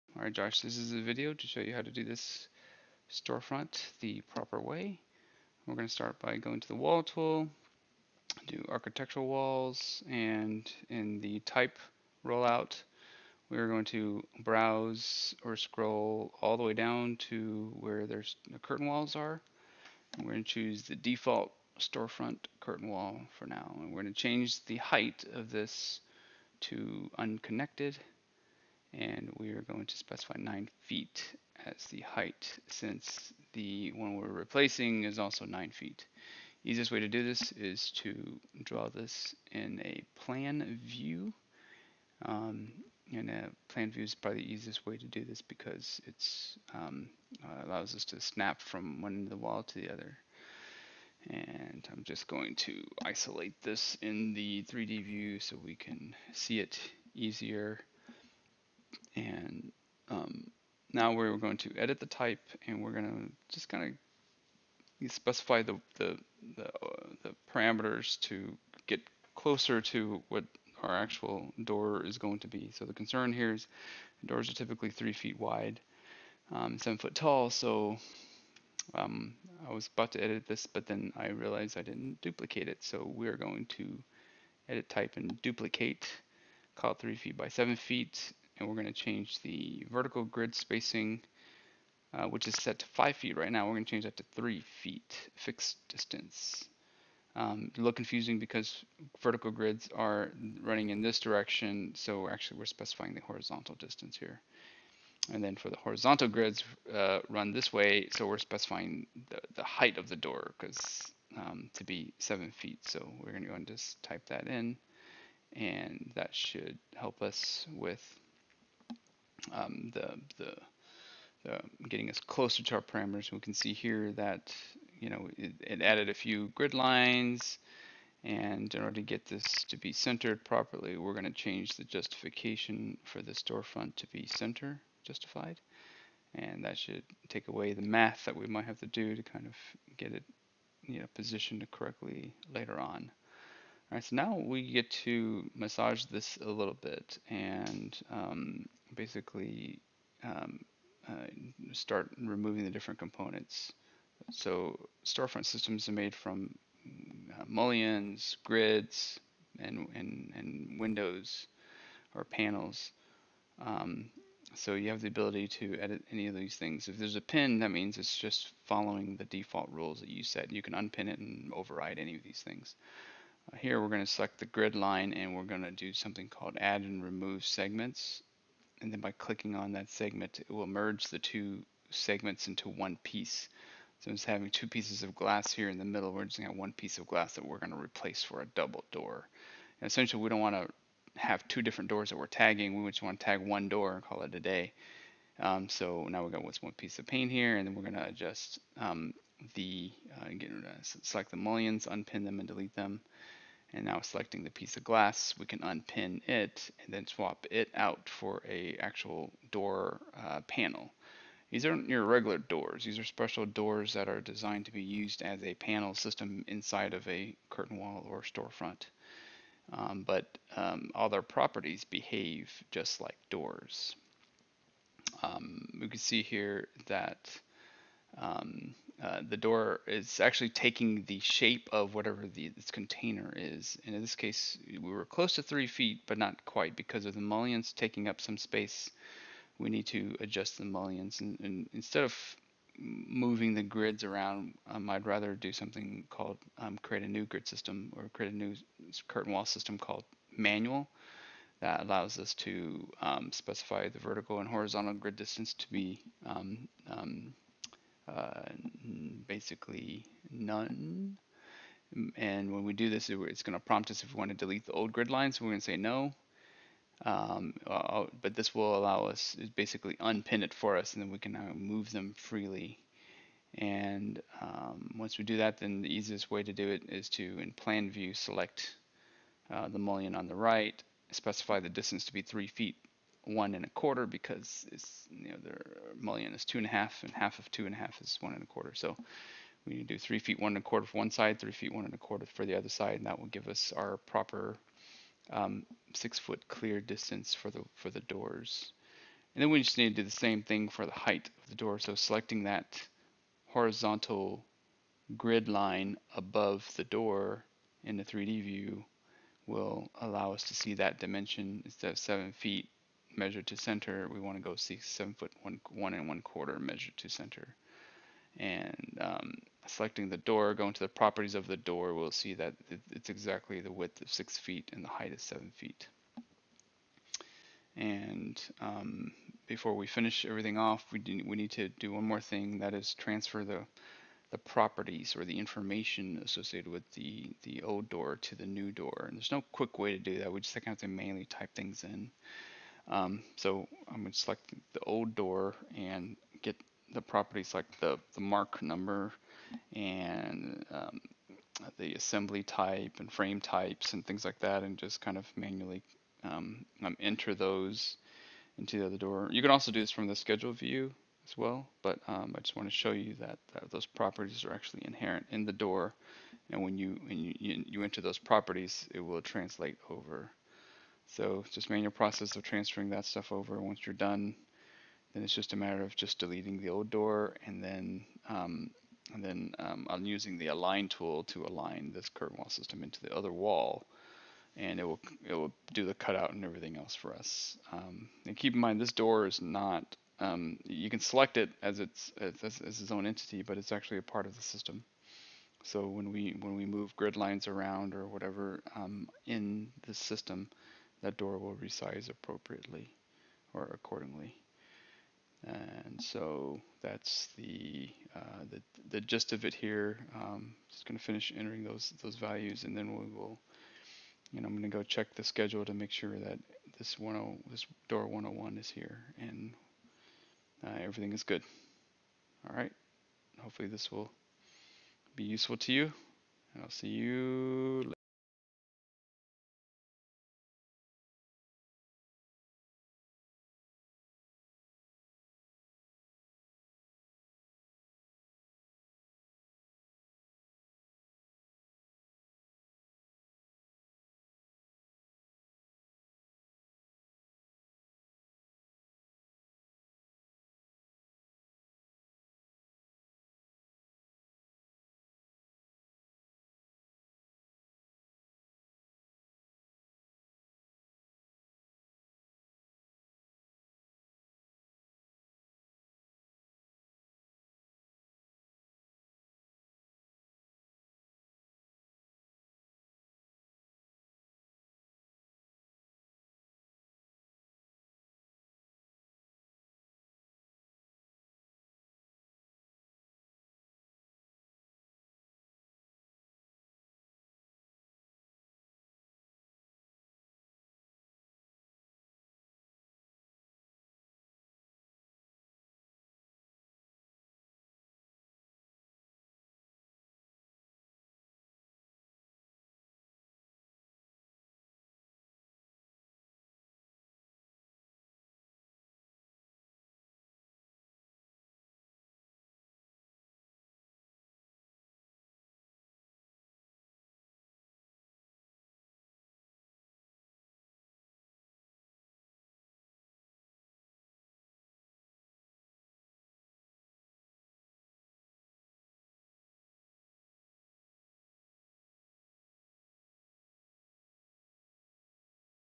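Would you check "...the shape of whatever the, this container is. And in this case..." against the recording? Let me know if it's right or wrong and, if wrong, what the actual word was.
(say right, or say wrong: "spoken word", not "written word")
right.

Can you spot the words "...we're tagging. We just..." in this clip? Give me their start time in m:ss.
3:12.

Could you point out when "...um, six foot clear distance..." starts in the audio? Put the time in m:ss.
4:55.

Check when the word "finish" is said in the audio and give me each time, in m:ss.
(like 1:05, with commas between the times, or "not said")
5:29, 6:51.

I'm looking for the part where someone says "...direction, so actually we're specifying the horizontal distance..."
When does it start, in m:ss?
1:41.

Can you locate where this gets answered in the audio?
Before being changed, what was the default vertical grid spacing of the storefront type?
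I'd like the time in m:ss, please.
1:32.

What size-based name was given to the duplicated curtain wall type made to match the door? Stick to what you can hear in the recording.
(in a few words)
three feet by seven feet.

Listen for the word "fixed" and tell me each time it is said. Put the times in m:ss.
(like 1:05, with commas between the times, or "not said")
1:35.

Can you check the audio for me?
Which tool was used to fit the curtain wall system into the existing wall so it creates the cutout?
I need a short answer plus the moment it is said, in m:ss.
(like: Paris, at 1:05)
align tool, at 6:20.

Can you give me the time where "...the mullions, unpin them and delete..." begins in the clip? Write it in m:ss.
3:21.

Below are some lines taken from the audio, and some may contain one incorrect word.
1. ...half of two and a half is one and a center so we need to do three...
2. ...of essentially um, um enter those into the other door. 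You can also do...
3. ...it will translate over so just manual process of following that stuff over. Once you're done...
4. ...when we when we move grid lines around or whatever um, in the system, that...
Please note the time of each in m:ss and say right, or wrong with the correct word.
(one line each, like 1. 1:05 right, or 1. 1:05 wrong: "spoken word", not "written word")
1. 4:47 wrong: "quarter", not "center"
2. 5:55 wrong: "manually", not "essentially"
3. 6:08 wrong: "transferring", not "following"
4. 6:35 right.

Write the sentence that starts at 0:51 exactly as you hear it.
And I'm just going to isolate this in the 3D view so we can see it easier.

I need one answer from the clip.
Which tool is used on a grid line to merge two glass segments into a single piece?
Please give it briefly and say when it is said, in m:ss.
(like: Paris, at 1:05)
add and remove segments, at 2:56.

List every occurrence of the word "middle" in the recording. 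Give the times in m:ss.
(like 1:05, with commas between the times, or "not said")
3:05.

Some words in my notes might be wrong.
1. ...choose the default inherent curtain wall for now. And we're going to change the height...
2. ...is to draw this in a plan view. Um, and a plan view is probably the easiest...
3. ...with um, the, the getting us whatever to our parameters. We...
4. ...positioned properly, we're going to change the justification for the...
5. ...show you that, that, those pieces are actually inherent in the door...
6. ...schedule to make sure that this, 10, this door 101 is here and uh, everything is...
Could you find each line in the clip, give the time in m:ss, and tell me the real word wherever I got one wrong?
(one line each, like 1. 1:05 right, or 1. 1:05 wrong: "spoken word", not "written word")
1. 0:20 wrong: "storefront", not "inherent"
2. 0:37 right
3. 1:57 wrong: "closer", not "whatever"
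4. 2:09 wrong: "centered", not "positioned"
5. 6:02 wrong: "properties", not "pieces"
6. 6:55 right.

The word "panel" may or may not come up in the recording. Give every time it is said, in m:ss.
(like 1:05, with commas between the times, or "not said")
2:42, 3:30, 3:35.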